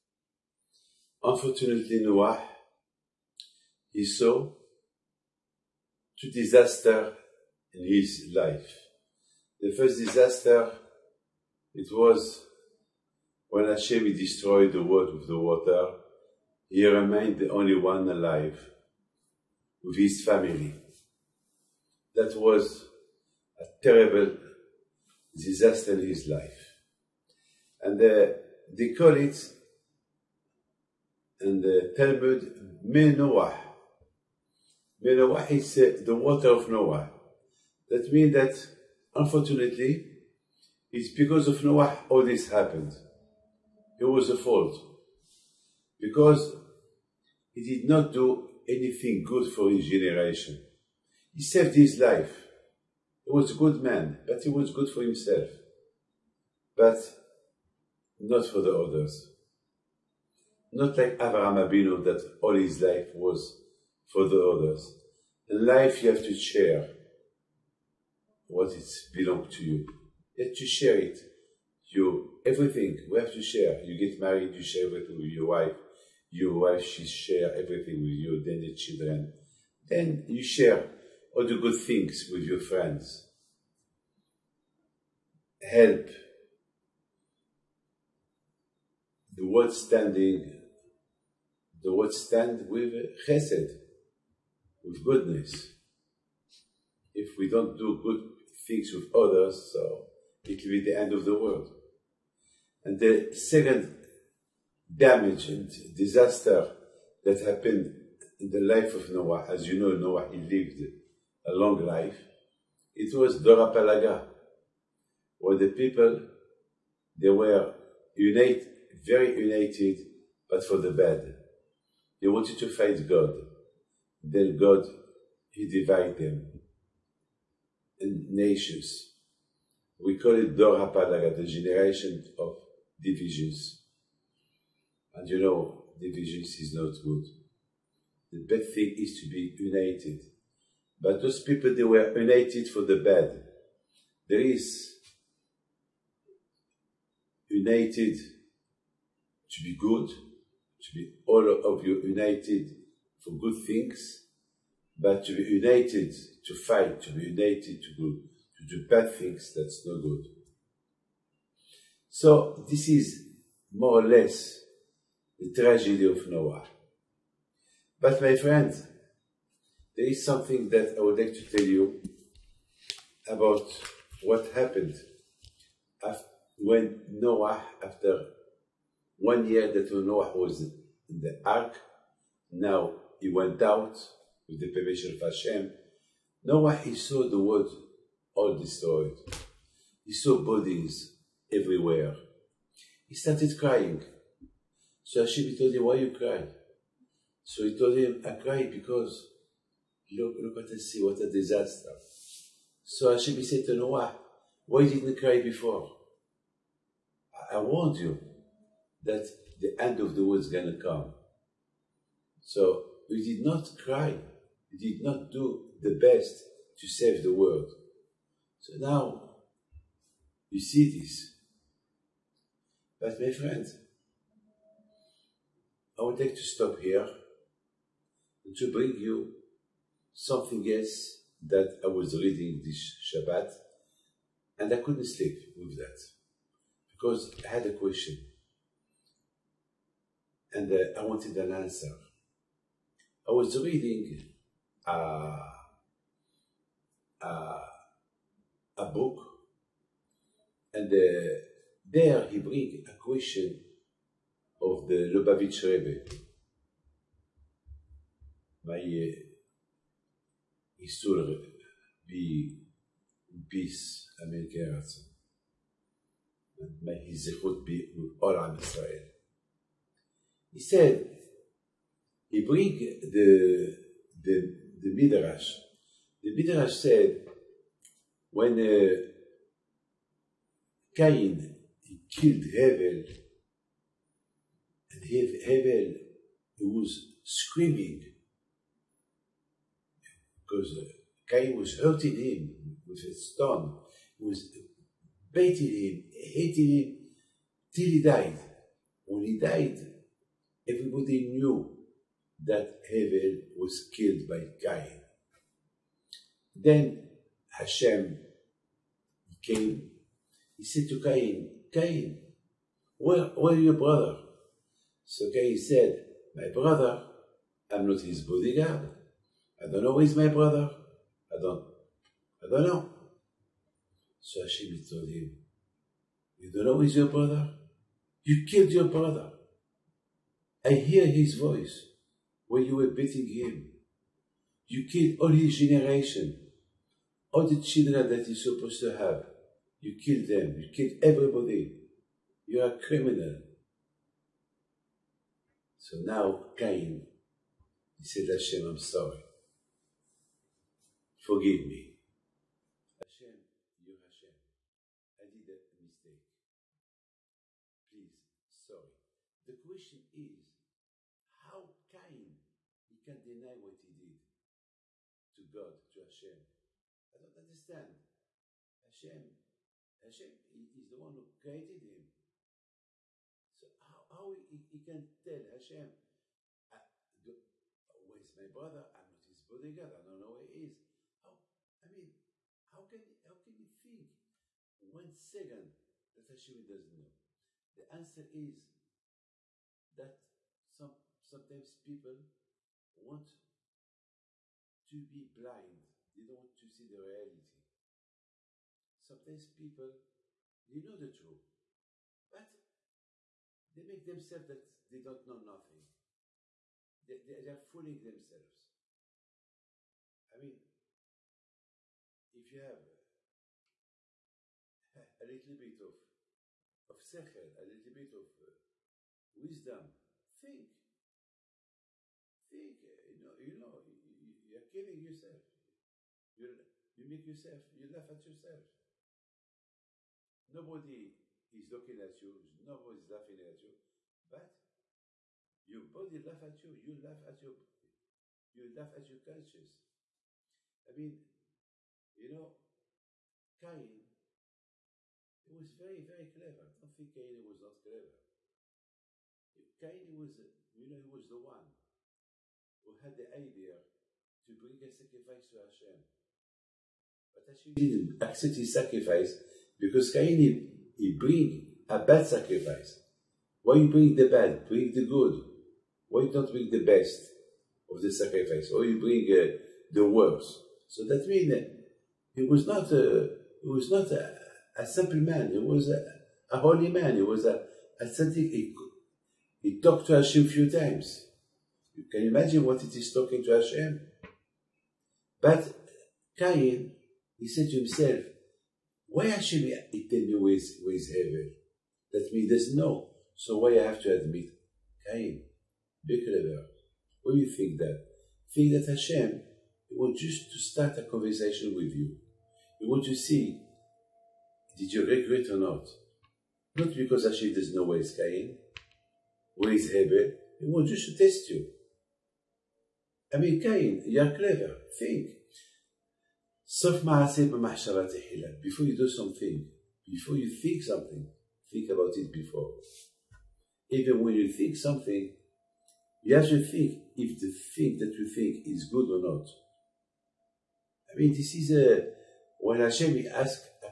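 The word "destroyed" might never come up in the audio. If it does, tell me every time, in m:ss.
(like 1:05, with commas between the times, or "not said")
0:14, 3:08.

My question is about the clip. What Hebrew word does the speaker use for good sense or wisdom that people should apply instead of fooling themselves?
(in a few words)
sechel.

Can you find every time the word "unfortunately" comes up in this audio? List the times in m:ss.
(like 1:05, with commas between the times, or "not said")
0:01, 0:39.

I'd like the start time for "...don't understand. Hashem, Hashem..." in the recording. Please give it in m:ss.
6:07.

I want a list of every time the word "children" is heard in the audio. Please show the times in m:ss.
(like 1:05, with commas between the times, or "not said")
1:18, 5:37.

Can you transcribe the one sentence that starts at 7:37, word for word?
But Hashem didn't accept his sacrifice because Cain, he, he bring a bad sacrifice.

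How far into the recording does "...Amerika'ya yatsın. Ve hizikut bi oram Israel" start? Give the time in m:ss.
4:24.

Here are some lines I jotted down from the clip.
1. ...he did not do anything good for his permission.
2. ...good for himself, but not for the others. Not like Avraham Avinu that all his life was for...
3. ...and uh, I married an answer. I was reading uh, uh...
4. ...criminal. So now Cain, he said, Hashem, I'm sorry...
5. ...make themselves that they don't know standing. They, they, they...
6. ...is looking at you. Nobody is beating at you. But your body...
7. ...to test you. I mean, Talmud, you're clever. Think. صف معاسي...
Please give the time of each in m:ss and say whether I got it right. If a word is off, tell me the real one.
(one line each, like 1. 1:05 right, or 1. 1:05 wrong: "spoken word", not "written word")
1. 0:47 wrong: "generation", not "permission"
2. 0:54 right
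3. 4:00 wrong: "wanted", not "married"
4. 5:42 right
5. 6:43 wrong: "nothing", not "standing"
6. 7:11 wrong: "laughing", not "beating"
7. 8:31 wrong: "Cain", not "Talmud".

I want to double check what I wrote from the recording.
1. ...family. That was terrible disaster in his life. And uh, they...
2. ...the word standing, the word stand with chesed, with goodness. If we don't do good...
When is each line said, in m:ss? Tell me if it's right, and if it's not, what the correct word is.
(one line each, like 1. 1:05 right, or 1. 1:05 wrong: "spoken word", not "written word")
1. 0:20 right
2. 1:29 right.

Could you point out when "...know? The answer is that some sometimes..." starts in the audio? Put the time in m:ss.
6:26.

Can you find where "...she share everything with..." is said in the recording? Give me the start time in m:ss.
1:16.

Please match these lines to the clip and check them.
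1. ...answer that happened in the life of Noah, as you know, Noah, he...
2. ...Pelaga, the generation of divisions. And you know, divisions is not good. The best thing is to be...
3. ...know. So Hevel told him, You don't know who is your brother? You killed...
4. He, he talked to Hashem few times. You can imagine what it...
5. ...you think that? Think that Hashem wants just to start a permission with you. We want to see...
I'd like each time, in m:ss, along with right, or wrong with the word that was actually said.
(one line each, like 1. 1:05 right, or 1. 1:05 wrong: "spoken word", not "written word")
1. 1:45 wrong: "disaster", not "answer"
2. 2:10 right
3. 5:22 wrong: "Hashem", not "Hevel"
4. 7:58 right
5. 8:17 wrong: "conversation", not "permission".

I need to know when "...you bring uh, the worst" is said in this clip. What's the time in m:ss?
7:48.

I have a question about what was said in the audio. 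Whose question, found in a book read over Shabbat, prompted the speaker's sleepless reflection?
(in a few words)
the Lubavitch Rebbe.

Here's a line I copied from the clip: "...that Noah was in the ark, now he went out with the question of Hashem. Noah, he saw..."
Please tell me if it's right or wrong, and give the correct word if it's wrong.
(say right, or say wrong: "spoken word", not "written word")
wrong: "permission", not "question".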